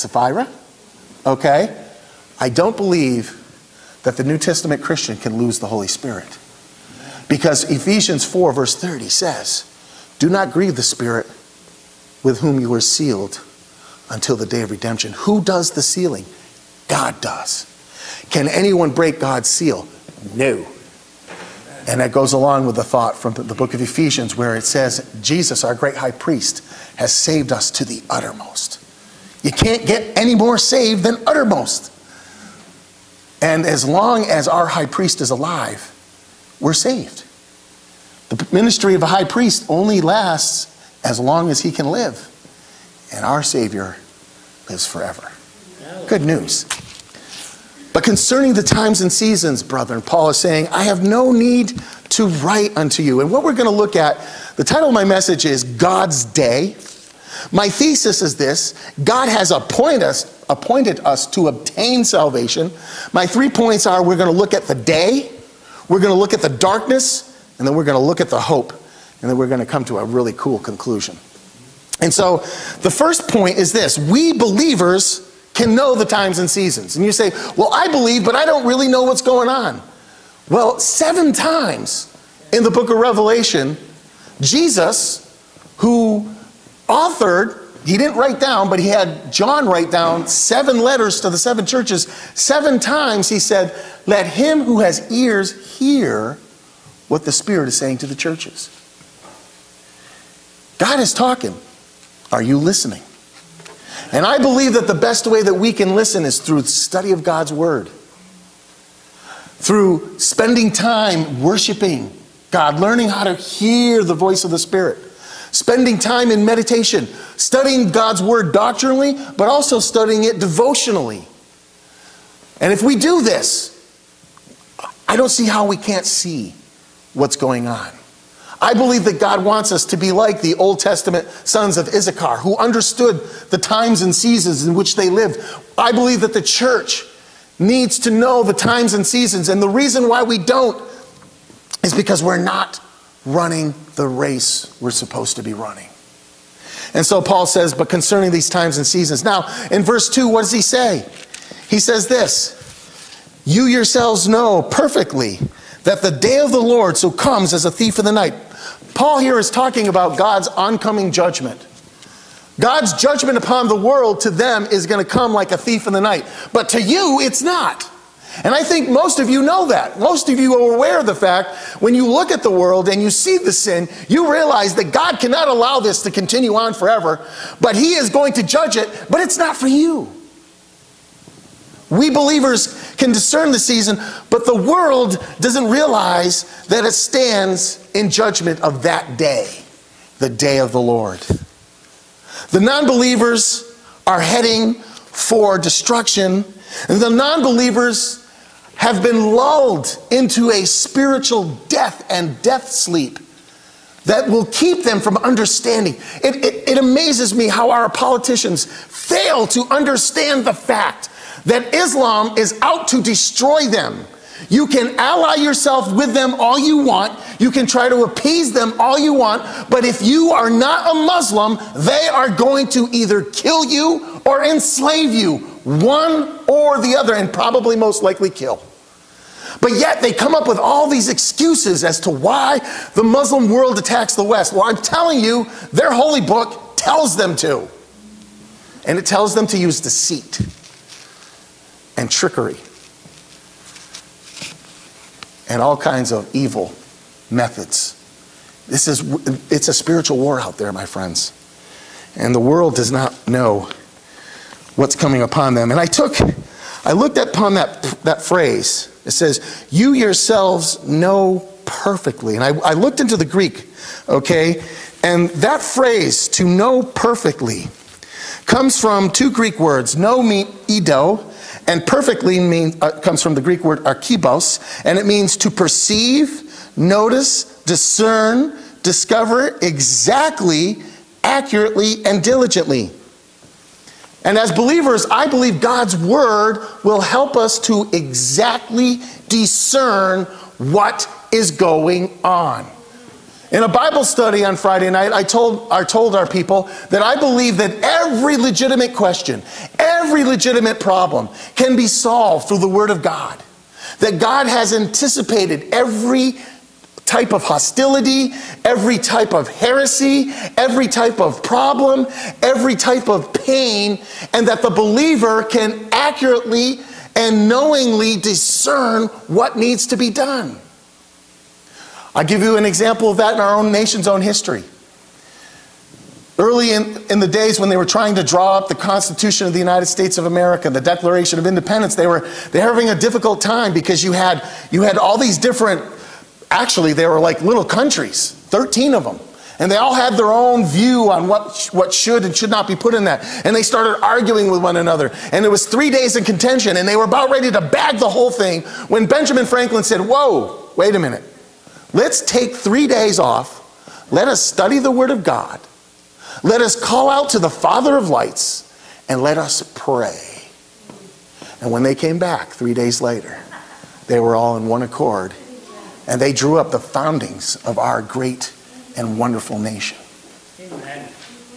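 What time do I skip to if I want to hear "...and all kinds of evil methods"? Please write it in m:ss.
4:05.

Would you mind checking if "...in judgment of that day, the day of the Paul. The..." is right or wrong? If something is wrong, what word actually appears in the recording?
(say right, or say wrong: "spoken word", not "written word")
wrong: "Lord", not "Paul".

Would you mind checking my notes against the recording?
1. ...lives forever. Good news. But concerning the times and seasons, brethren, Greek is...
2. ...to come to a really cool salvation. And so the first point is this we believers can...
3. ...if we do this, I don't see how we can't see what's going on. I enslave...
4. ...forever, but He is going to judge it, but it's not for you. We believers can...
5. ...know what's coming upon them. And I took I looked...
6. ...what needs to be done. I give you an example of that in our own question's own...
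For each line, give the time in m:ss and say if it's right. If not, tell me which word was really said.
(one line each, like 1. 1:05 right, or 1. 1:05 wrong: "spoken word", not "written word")
1. 0:44 wrong: "Paul", not "Greek"
2. 1:09 wrong: "conclusion", not "salvation"
3. 2:02 wrong: "believe", not "enslave"
4. 2:56 right
5. 4:13 right
6. 5:19 wrong: "nation", not "question".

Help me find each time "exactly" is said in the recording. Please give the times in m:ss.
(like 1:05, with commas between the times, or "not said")
4:39, 4:47.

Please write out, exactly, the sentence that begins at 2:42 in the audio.
God's judgment upon the world to them is going to come like a thief in the night, but to you, it's not.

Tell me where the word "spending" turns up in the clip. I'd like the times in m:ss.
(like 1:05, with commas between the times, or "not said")
1:50, 1:55.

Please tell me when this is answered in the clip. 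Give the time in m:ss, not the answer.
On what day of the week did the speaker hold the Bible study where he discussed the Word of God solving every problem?
4:54.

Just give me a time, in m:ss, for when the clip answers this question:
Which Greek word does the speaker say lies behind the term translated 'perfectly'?
4:33.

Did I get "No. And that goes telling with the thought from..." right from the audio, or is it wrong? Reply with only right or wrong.
wrong.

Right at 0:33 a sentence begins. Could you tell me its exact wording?
And as long as our high priest is alive, we're saved.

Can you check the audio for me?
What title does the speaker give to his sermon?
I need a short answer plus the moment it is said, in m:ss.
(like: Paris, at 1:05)
God's Day, at 0:55.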